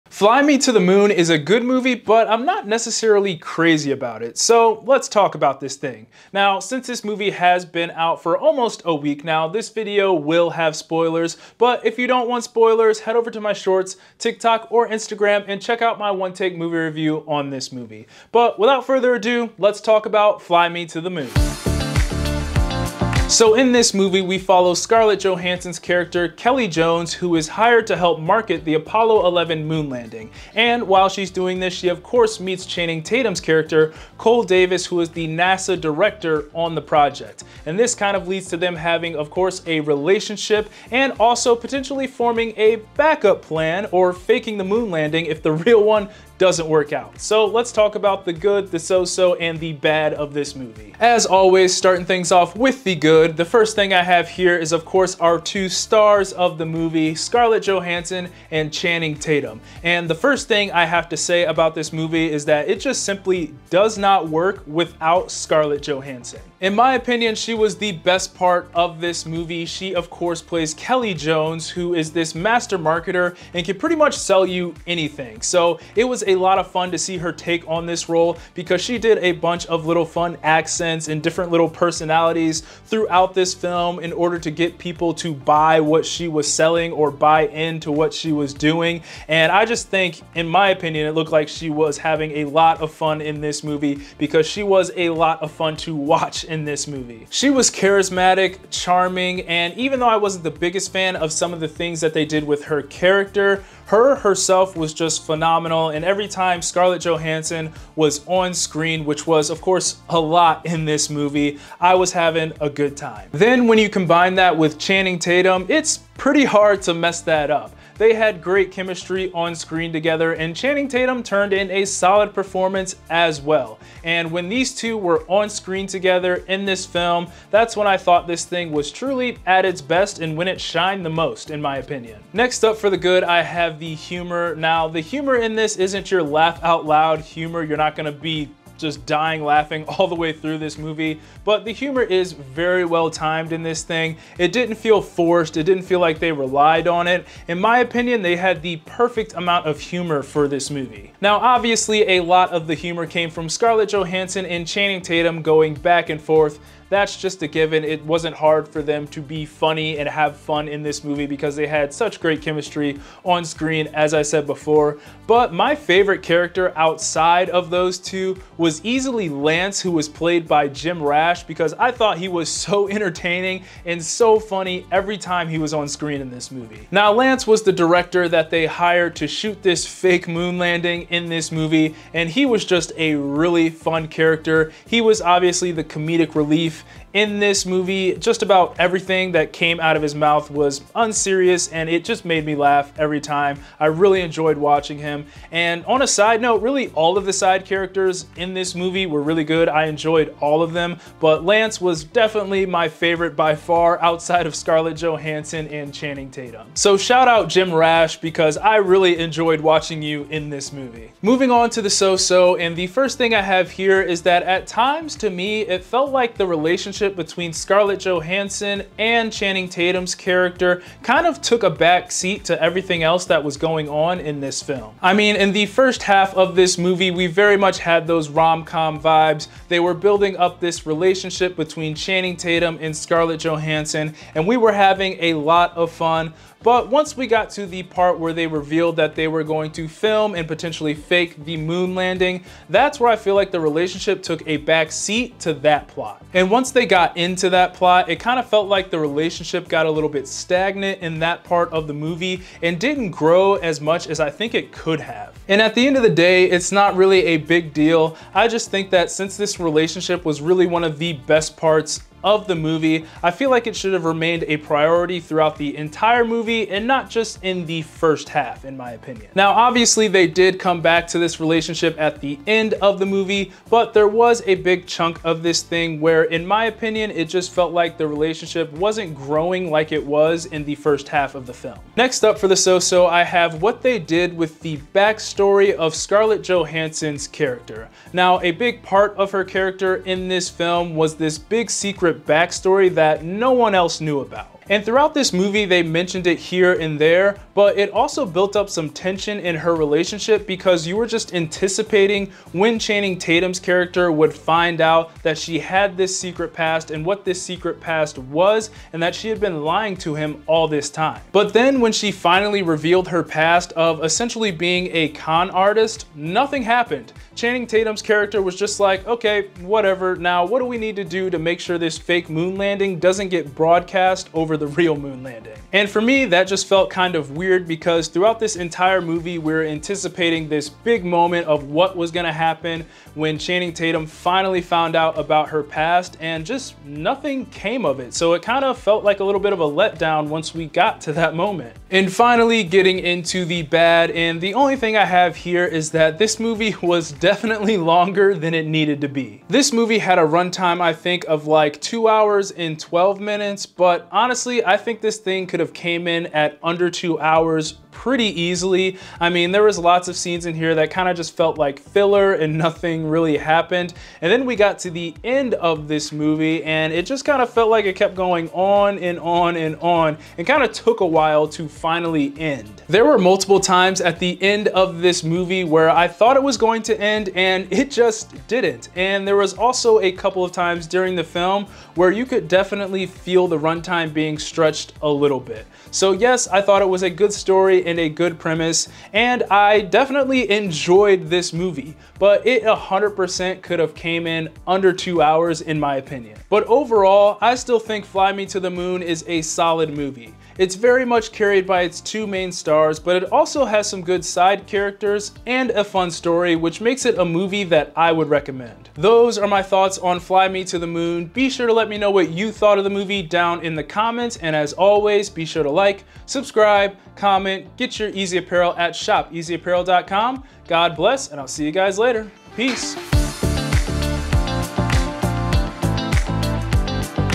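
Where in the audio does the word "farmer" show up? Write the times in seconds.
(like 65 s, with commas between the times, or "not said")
not said.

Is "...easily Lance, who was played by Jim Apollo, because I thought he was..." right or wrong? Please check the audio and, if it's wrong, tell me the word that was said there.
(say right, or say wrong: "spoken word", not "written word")
wrong: "Rash", not "Apollo".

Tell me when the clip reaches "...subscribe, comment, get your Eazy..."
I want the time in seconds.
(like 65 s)
416 s.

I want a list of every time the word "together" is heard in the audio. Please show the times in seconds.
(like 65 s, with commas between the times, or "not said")
119 s, 125 s.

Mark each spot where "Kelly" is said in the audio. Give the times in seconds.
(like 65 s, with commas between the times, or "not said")
26 s, 70 s.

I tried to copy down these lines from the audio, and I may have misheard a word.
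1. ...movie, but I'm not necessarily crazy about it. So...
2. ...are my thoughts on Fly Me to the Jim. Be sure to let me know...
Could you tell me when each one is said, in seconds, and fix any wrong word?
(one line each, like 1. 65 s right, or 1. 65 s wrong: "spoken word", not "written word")
1. 1 s right
2. 409 s wrong: "Moon", not "Jim".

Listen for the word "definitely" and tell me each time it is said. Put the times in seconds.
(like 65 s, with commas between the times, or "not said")
202 s, 347 s, 382 s, 389 s.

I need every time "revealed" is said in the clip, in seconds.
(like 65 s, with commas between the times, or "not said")
238 s, 312 s.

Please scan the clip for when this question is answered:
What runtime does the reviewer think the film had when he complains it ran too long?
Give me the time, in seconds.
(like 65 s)
351 s.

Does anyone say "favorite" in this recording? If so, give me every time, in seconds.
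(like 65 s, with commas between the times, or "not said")
165 s, 202 s.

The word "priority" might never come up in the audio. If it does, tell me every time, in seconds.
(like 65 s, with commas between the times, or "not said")
264 s.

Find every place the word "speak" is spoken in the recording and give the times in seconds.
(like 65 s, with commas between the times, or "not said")
not said.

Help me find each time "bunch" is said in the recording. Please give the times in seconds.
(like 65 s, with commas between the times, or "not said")
79 s.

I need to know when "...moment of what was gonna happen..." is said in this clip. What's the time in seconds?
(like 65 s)
331 s.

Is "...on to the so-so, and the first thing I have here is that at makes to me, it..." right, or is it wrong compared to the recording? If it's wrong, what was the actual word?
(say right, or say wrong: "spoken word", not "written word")
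wrong: "times", not "makes".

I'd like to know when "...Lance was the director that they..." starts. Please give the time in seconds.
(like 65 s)
177 s.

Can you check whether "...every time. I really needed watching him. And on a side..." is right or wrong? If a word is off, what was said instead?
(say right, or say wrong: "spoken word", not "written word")
wrong: "enjoyed", not "needed".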